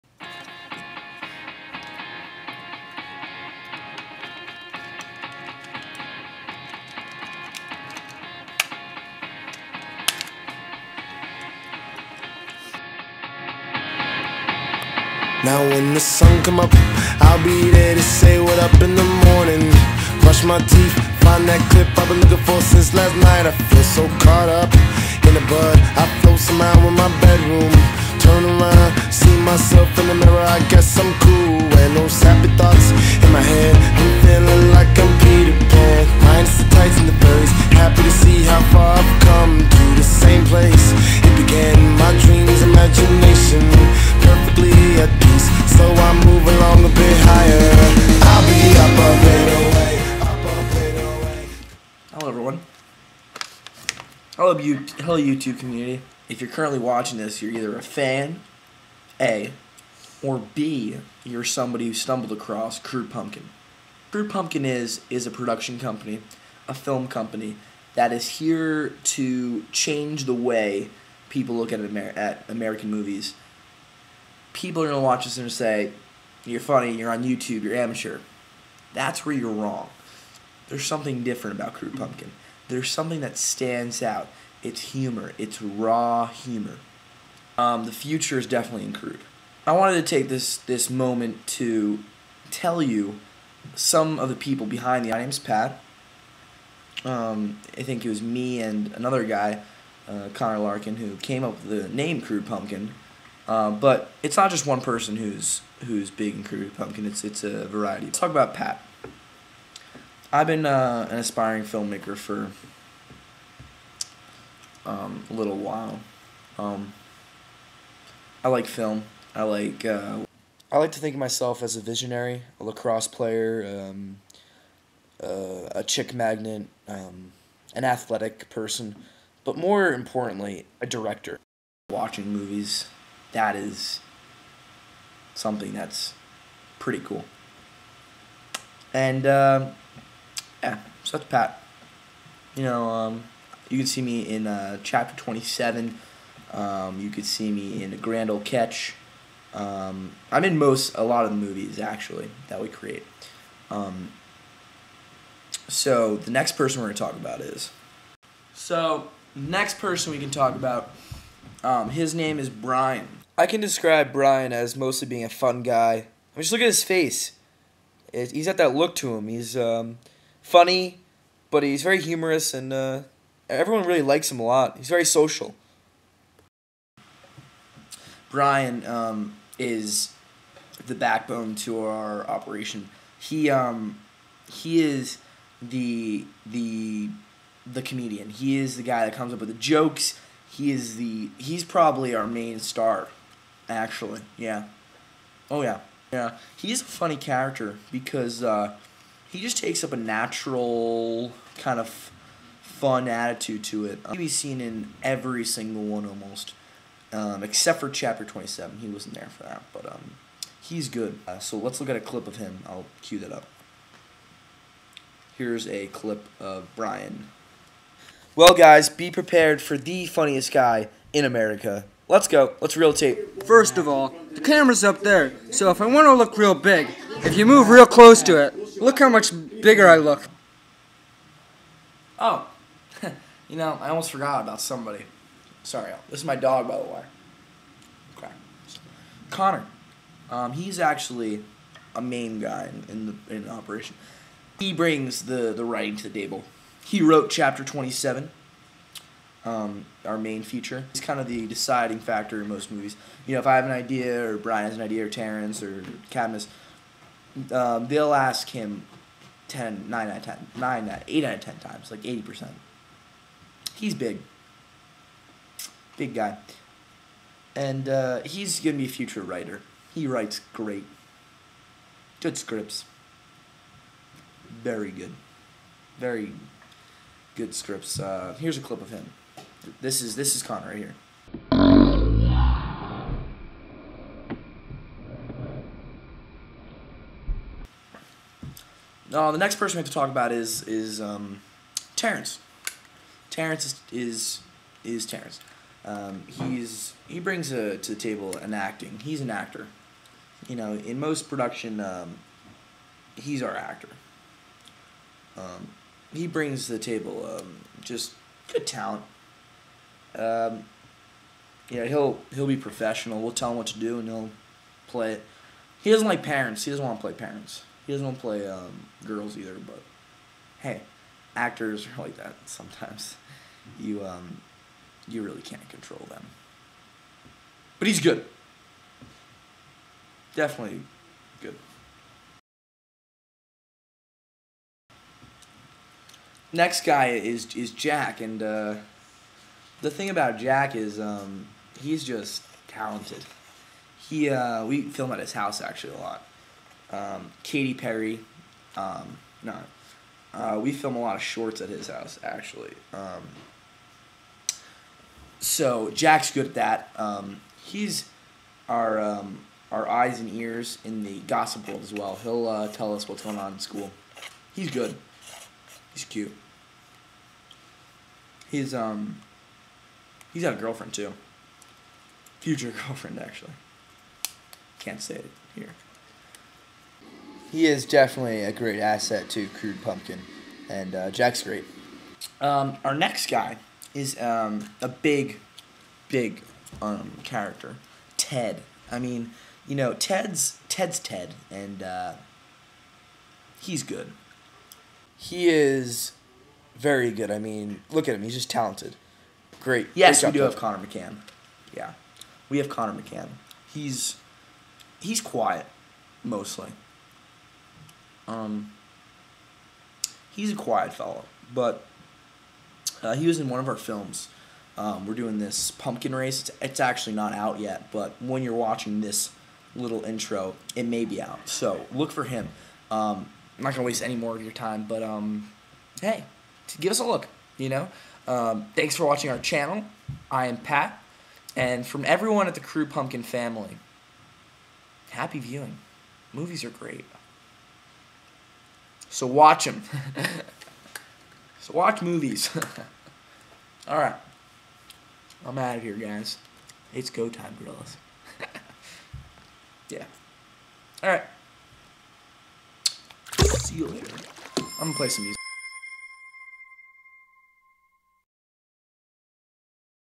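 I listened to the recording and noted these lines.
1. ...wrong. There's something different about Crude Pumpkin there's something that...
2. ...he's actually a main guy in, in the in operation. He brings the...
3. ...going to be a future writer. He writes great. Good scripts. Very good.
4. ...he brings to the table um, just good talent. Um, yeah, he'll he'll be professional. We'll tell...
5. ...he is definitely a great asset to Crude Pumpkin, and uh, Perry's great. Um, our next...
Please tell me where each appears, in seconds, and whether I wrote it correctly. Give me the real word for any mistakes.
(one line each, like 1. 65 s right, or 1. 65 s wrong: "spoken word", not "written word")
1. 79 s right
2. 240 s right
3. 268 s right
4. 306 s right
5. 377 s wrong: "Jack", not "Perry".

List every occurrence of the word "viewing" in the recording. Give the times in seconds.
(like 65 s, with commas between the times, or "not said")
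435 s.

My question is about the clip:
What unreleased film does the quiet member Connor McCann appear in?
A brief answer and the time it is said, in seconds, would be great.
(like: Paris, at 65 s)
pumpkin race, at 415 s.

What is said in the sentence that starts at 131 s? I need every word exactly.
Watching movies, that is something that's pretty cool.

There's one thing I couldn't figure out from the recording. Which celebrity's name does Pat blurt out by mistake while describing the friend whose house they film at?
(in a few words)
Katy Perry.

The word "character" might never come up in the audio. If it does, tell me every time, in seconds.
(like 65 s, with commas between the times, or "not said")
197 s, 387 s.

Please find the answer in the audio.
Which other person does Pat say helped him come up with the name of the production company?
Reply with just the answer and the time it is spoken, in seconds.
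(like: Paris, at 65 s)
Connor Larkin, at 100 s.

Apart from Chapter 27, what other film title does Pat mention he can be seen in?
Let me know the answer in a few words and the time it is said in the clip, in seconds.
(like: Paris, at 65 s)
Grand Old Catch, at 147 s.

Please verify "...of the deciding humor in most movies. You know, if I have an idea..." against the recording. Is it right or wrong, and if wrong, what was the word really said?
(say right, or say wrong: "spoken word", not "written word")
wrong: "factor", not "humor".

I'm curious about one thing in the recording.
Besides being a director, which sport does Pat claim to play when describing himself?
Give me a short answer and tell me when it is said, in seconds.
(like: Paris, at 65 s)
lacrosse, at 122 s.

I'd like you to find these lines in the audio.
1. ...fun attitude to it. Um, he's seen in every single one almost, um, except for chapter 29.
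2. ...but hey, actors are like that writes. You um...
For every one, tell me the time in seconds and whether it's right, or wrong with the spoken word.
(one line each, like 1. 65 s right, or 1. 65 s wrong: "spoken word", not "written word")
1. 202 s wrong: "27", not "29"
2. 319 s wrong: "sometimes", not "writes".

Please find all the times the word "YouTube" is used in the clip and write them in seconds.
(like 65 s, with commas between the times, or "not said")
55 s, 77 s.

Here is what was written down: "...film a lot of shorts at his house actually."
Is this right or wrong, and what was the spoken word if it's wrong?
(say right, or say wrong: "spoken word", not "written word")
right.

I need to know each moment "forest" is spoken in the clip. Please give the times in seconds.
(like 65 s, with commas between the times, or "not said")
not said.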